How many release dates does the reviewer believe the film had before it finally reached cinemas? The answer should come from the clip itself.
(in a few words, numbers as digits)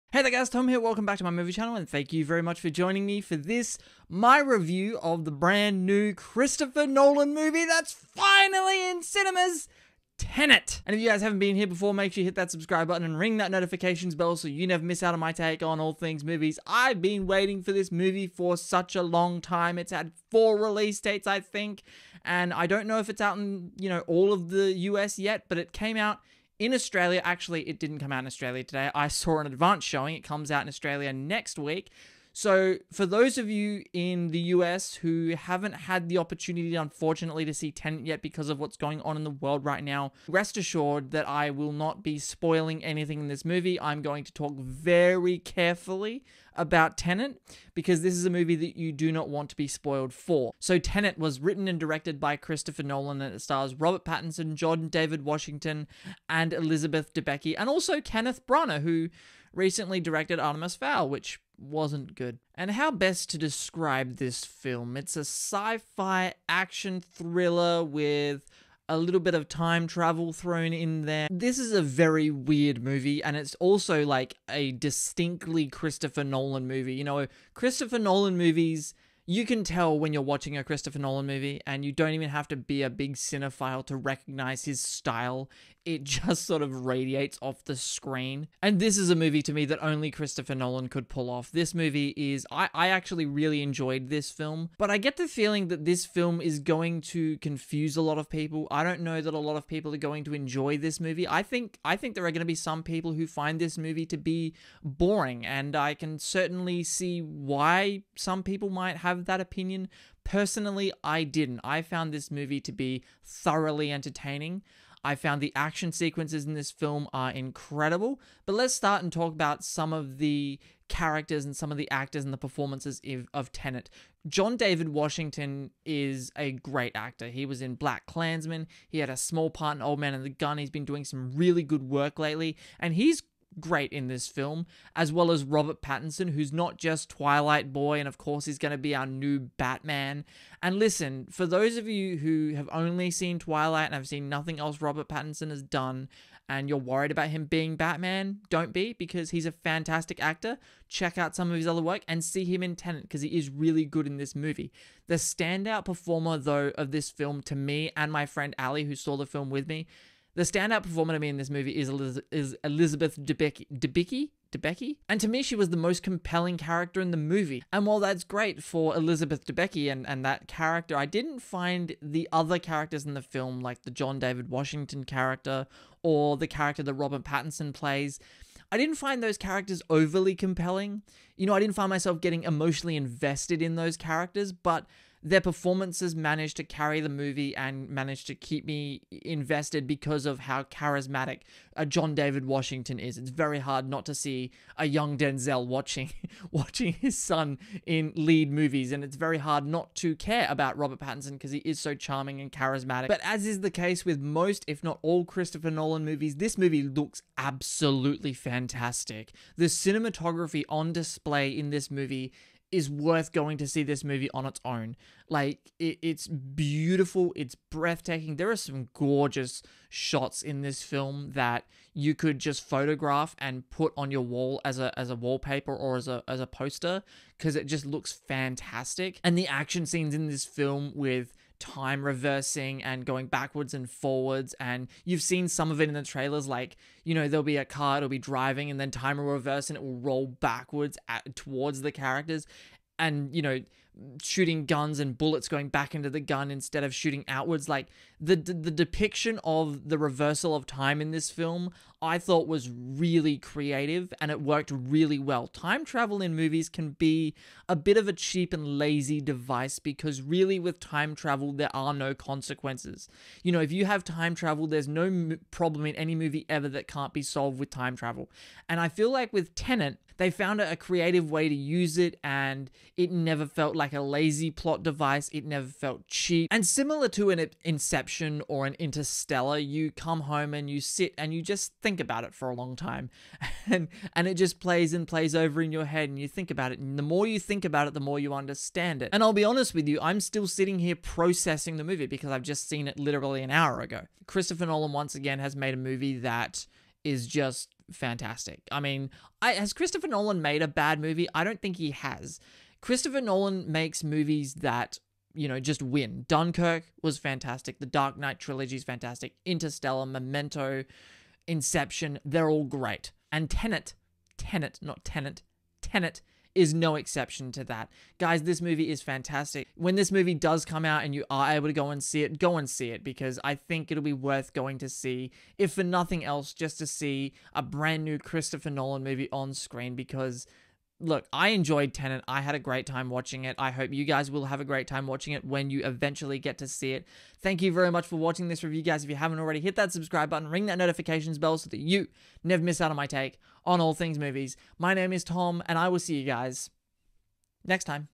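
4.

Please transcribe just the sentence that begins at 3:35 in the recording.
Like, it, it's beautiful, it's breathtaking.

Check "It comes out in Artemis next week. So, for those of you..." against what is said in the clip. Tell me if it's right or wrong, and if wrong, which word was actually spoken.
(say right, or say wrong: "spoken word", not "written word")
wrong: "Australia", not "Artemis".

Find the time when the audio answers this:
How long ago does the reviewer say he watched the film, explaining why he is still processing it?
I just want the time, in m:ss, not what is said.
4:53.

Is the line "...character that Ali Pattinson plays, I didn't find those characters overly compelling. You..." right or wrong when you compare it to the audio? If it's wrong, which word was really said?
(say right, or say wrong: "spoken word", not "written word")
wrong: "Robert", not "Ali".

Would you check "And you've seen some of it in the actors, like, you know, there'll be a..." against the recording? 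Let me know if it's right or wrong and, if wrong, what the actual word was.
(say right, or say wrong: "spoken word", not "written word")
wrong: "trailers", not "actors".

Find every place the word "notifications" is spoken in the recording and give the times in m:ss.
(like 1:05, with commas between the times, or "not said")
0:13, 5:40.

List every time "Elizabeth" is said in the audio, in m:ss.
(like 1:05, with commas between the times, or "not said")
0:56, 2:42, 2:48.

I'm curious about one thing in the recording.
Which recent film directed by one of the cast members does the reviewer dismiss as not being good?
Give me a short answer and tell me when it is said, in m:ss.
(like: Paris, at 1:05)
Artemis Fowl, at 1:00.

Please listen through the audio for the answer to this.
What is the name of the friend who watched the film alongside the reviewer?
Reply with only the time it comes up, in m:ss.
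2:38.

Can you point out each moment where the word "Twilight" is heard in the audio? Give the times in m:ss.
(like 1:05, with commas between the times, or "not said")
2:17, 2:23.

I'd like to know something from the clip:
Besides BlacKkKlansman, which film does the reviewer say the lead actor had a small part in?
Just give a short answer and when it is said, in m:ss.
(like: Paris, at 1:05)
Old Man and the Gun, at 2:09.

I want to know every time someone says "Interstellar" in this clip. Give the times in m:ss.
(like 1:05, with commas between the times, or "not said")
4:38, 5:09.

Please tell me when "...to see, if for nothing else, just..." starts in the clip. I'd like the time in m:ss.
5:24.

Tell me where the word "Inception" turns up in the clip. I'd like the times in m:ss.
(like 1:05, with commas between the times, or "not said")
4:37, 5:11.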